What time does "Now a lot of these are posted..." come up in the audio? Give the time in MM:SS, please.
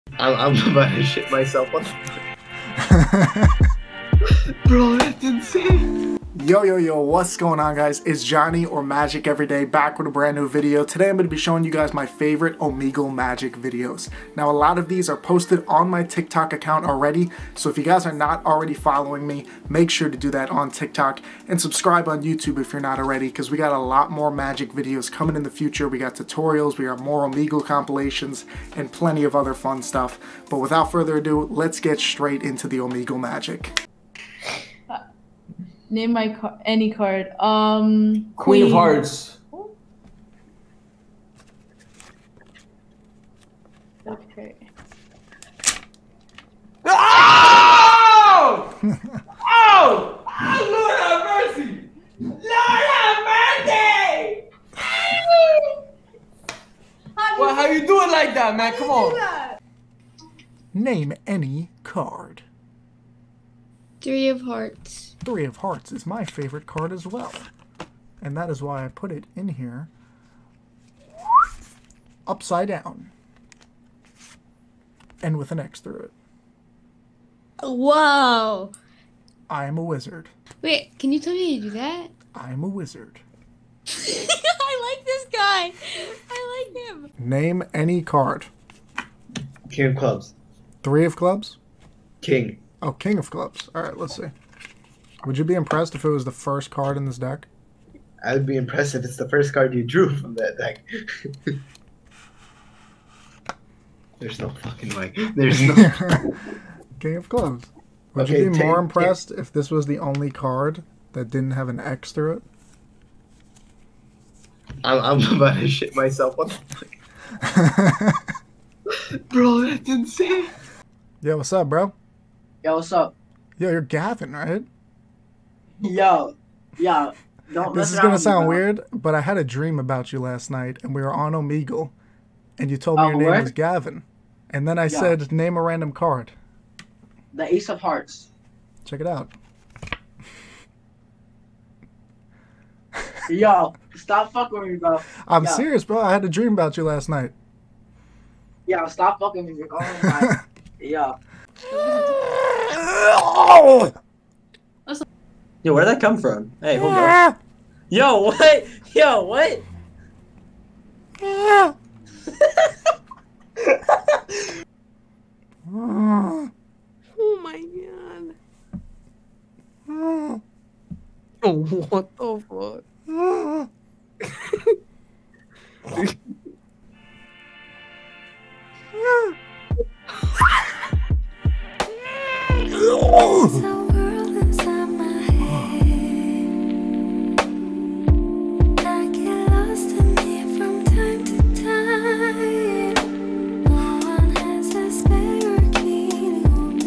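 00:14.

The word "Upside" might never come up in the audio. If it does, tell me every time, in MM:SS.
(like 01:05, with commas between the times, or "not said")
01:12.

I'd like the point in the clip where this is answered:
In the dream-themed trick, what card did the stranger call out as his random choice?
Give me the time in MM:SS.
02:17.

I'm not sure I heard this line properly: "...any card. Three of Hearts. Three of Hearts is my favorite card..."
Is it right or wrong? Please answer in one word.
right.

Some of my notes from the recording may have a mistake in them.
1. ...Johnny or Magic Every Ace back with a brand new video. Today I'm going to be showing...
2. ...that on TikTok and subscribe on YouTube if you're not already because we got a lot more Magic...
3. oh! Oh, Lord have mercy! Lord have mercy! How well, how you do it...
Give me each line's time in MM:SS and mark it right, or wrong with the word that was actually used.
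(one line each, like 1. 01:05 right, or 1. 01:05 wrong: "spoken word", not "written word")
1. 00:08 wrong: "Day", not "Ace"
2. 00:20 right
3. 00:50 right.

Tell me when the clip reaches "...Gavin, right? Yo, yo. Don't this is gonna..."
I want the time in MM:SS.
02:03.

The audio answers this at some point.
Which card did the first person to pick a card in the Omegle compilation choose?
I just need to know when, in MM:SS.
00:38.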